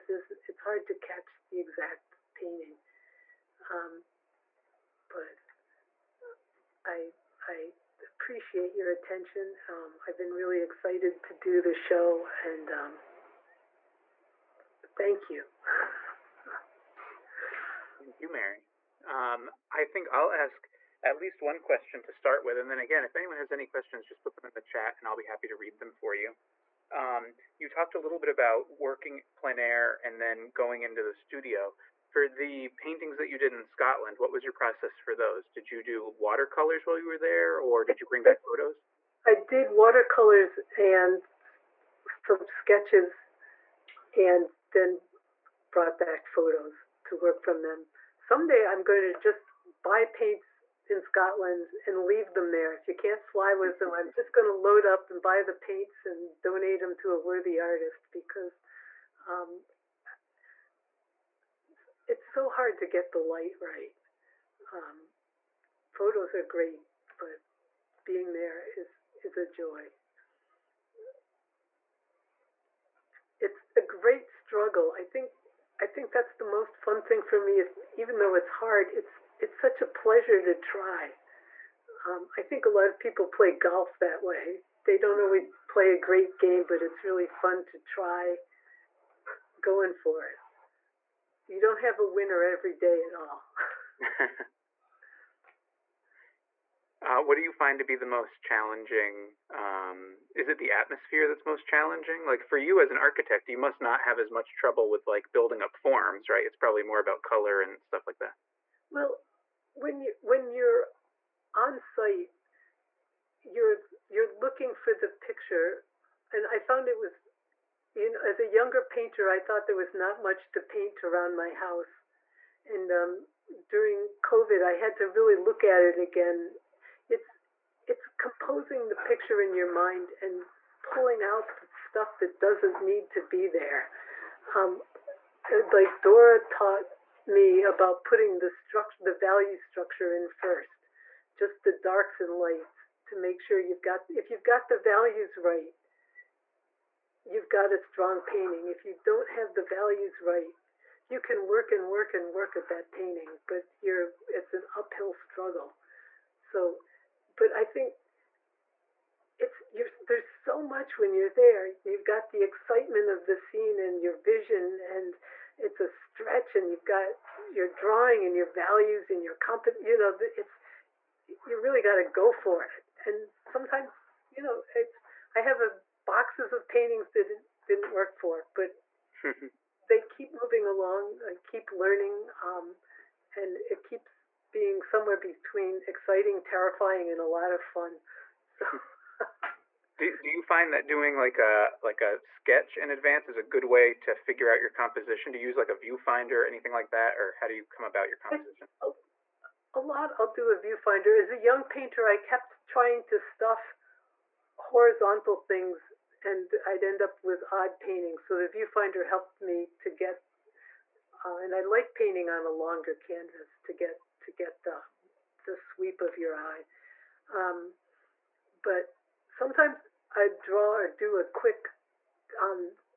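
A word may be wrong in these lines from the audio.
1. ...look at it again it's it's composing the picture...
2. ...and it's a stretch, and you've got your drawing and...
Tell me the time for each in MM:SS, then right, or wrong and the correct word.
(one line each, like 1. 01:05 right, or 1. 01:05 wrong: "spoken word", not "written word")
1. 02:05 right
2. 02:44 right.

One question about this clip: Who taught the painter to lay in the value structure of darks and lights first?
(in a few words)
Dora.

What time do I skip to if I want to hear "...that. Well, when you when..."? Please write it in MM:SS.
01:48.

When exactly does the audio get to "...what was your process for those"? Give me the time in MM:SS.
00:34.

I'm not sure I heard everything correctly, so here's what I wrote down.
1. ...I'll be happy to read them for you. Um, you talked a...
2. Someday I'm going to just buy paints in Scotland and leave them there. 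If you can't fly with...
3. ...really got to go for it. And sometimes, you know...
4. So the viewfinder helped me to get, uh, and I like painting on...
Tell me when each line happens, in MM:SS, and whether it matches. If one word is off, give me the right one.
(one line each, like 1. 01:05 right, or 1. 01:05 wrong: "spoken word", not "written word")
1. 00:25 right
2. 00:48 right
3. 02:51 right
4. 03:28 right.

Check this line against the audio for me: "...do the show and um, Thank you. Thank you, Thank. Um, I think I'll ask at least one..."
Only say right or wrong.
wrong.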